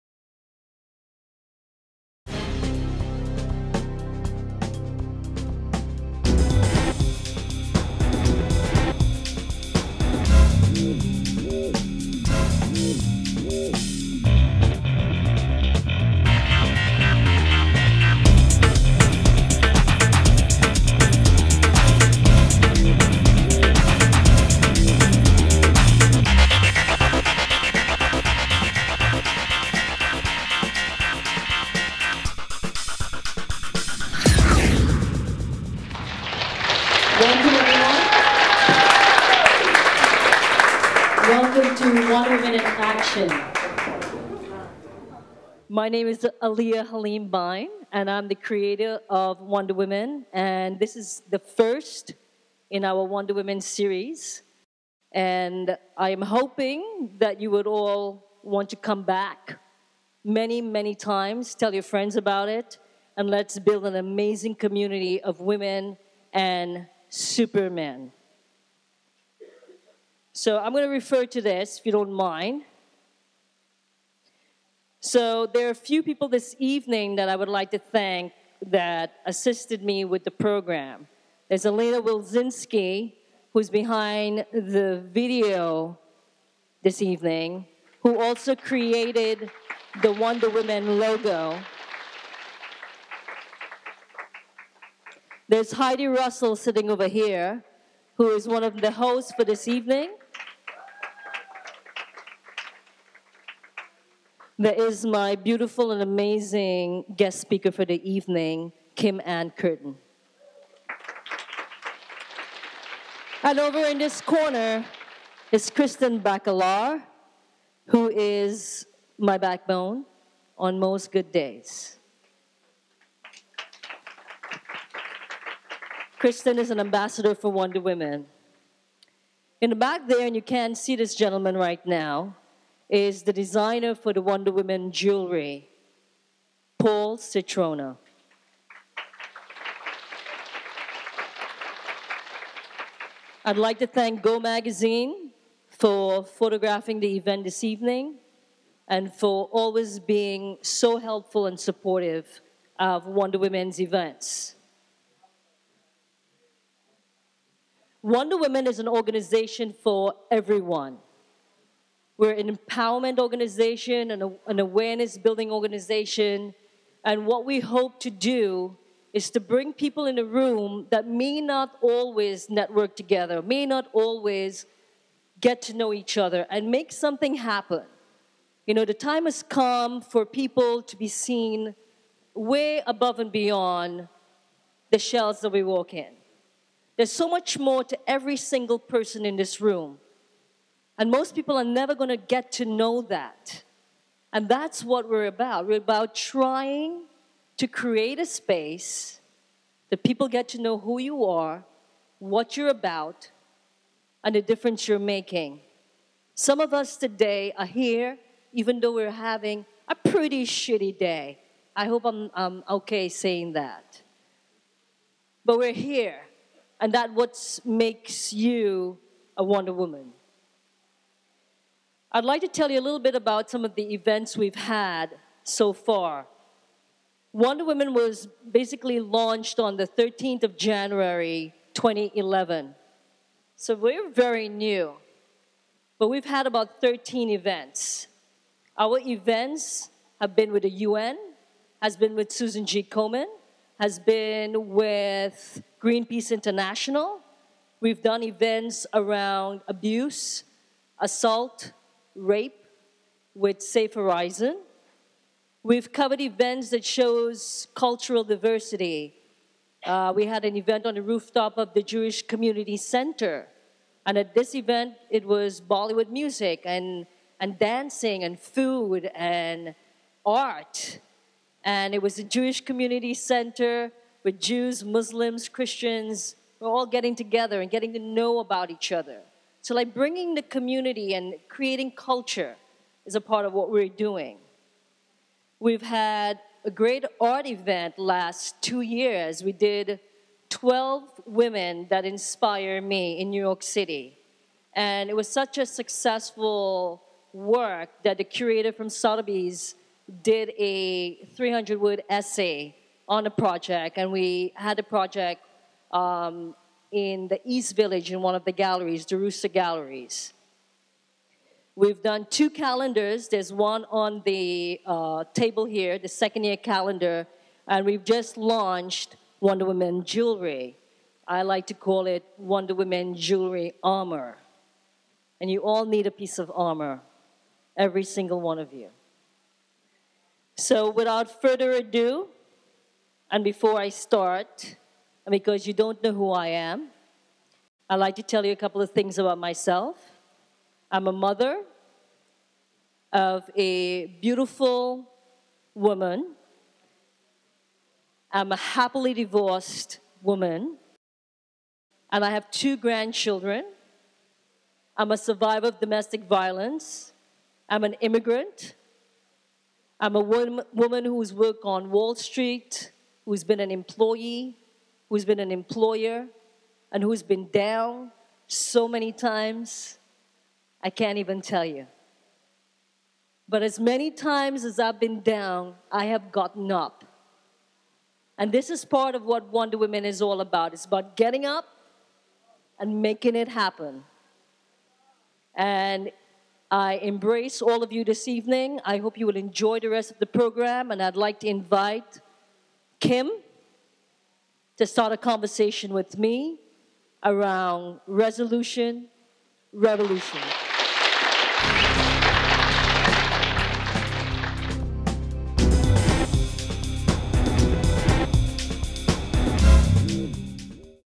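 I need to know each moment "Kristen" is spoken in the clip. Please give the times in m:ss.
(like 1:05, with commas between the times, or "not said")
1:55, 2:06.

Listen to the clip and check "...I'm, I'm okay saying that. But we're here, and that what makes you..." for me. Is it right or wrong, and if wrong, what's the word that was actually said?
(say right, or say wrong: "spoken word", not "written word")
right.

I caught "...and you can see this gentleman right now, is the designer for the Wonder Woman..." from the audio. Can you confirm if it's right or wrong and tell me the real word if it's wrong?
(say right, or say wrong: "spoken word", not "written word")
right.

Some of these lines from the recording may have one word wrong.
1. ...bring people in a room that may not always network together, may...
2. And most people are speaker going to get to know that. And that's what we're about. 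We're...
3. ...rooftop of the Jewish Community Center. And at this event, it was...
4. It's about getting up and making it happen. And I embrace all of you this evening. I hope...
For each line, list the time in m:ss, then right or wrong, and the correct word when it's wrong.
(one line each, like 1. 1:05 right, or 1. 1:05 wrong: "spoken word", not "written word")
1. 2:49 right
2. 3:10 wrong: "never", not "speaker"
3. 4:21 right
4. 6:20 right.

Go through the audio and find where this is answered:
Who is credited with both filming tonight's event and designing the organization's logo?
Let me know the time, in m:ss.
1:21.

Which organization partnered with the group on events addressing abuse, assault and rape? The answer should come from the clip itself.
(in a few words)
Safe Horizon.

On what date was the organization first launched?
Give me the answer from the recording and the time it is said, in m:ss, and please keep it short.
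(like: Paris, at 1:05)
13 January 2011, at 3:49.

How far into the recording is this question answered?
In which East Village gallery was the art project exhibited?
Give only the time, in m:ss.
5:09.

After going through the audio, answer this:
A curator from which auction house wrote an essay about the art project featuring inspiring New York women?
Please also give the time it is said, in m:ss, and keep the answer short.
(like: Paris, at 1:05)
Sotheby's, at 4:58.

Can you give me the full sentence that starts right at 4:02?
Komen, has been with Greenpeace International.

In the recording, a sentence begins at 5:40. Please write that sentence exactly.
I'm a mother of a beautiful woman.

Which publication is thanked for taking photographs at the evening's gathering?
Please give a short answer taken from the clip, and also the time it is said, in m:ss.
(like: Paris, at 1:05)
Go Magazine, at 2:24.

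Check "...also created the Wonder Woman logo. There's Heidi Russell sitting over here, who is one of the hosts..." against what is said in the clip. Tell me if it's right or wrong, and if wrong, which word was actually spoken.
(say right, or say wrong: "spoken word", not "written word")
right.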